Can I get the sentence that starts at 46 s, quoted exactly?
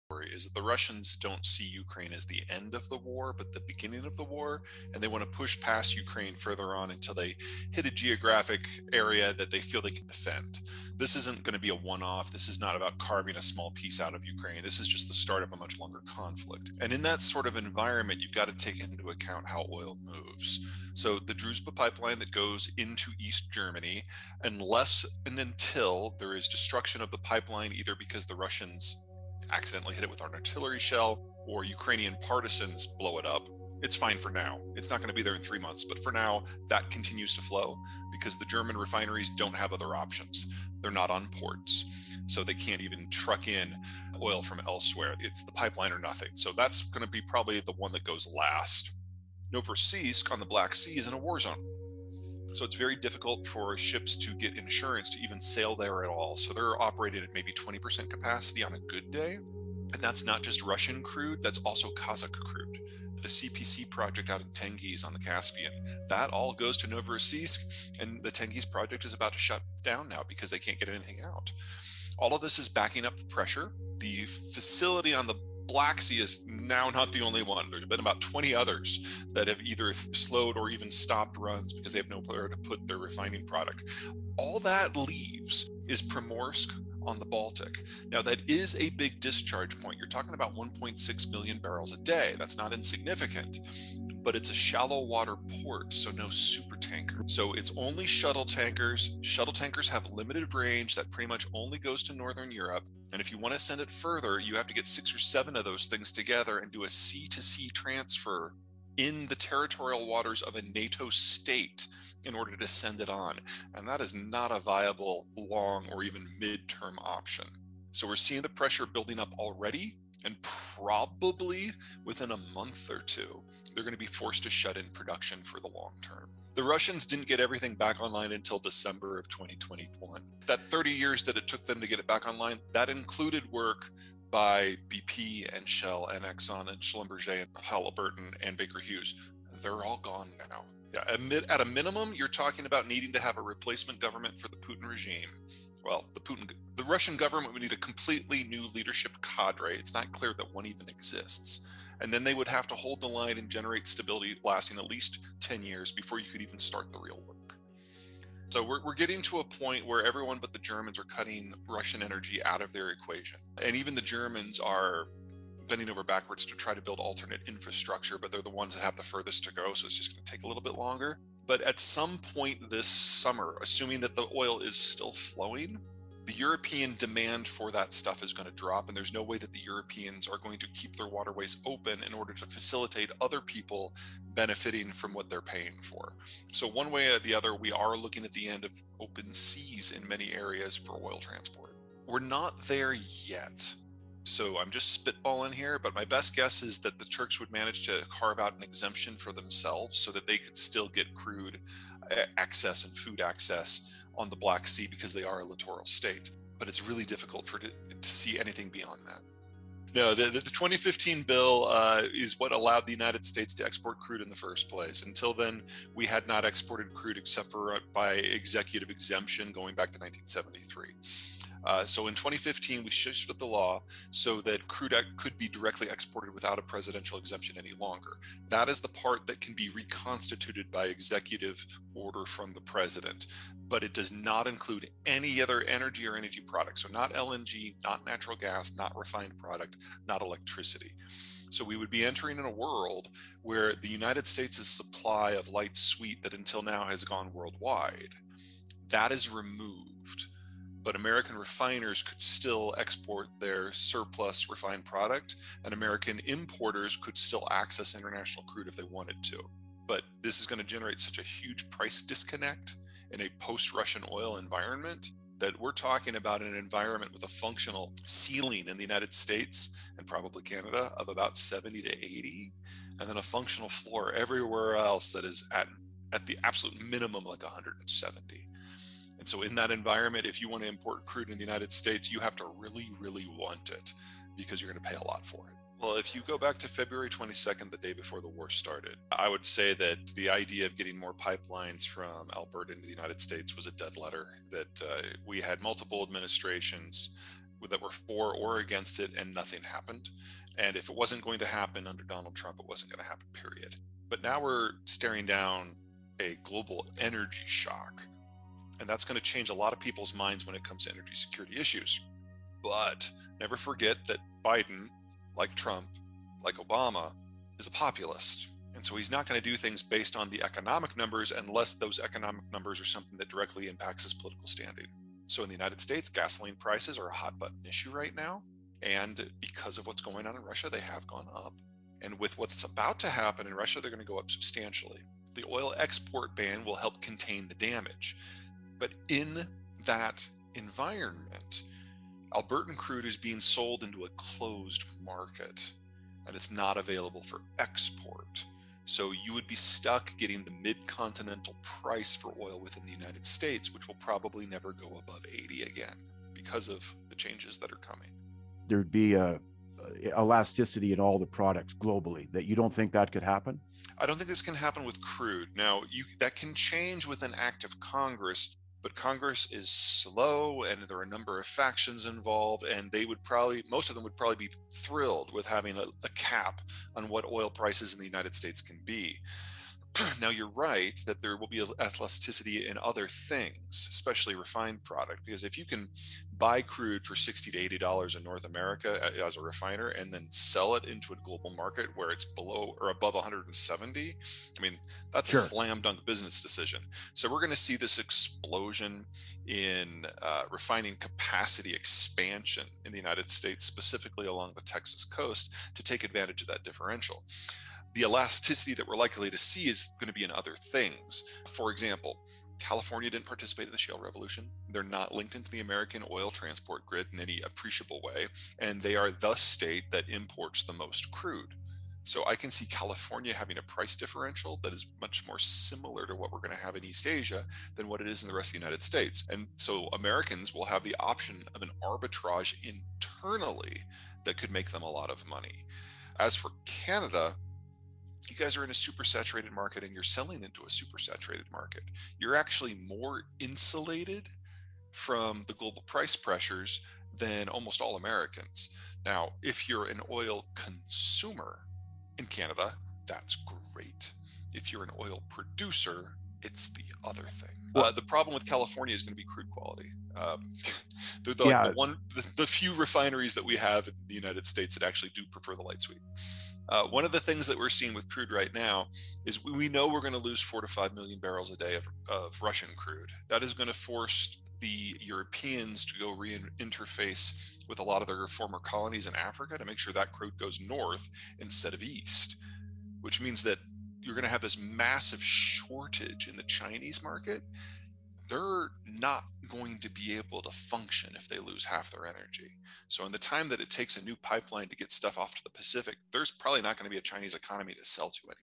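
So that's going to be probably the one that goes last.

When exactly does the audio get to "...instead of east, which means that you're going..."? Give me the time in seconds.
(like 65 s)
481 s.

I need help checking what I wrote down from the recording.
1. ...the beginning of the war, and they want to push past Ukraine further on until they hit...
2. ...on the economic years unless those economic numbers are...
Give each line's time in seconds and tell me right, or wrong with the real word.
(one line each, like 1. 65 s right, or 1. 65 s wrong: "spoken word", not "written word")
1. 3 s right
2. 320 s wrong: "numbers", not "years".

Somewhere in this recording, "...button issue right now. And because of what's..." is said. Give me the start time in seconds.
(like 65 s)
327 s.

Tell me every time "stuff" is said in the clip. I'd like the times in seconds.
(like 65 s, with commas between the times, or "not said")
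177 s, 494 s.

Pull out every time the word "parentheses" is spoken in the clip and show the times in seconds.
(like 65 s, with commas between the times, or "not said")
not said.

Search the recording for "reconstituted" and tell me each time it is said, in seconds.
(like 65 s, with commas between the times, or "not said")
229 s.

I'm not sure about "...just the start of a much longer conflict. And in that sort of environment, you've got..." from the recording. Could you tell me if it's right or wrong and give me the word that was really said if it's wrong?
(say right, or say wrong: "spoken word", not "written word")
right.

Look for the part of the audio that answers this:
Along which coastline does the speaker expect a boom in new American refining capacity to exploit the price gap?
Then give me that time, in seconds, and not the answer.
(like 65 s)
404 s.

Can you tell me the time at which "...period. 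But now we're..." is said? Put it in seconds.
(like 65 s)
303 s.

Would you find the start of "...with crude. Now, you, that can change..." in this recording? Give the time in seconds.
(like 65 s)
364 s.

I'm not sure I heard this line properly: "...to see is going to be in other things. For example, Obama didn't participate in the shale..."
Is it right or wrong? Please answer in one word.
wrong.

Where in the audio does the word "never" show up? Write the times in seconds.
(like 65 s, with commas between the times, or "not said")
313 s, 354 s.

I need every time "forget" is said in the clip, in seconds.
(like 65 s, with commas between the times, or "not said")
313 s.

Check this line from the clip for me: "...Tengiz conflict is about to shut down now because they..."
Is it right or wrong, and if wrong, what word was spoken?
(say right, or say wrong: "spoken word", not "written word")
wrong: "project", not "conflict".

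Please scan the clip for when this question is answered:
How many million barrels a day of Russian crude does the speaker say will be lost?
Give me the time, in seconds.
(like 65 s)
470 s.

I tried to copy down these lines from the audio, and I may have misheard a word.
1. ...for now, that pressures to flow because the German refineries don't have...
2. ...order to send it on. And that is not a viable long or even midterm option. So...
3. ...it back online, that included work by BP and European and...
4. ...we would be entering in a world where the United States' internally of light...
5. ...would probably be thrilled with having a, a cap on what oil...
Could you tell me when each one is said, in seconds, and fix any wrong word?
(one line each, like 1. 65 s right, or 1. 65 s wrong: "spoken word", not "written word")
1. 36 s wrong: "continues", not "pressures"
2. 112 s right
3. 131 s wrong: "Shell", not "European"
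4. 241 s wrong: "supply", not "internally"
5. 374 s right.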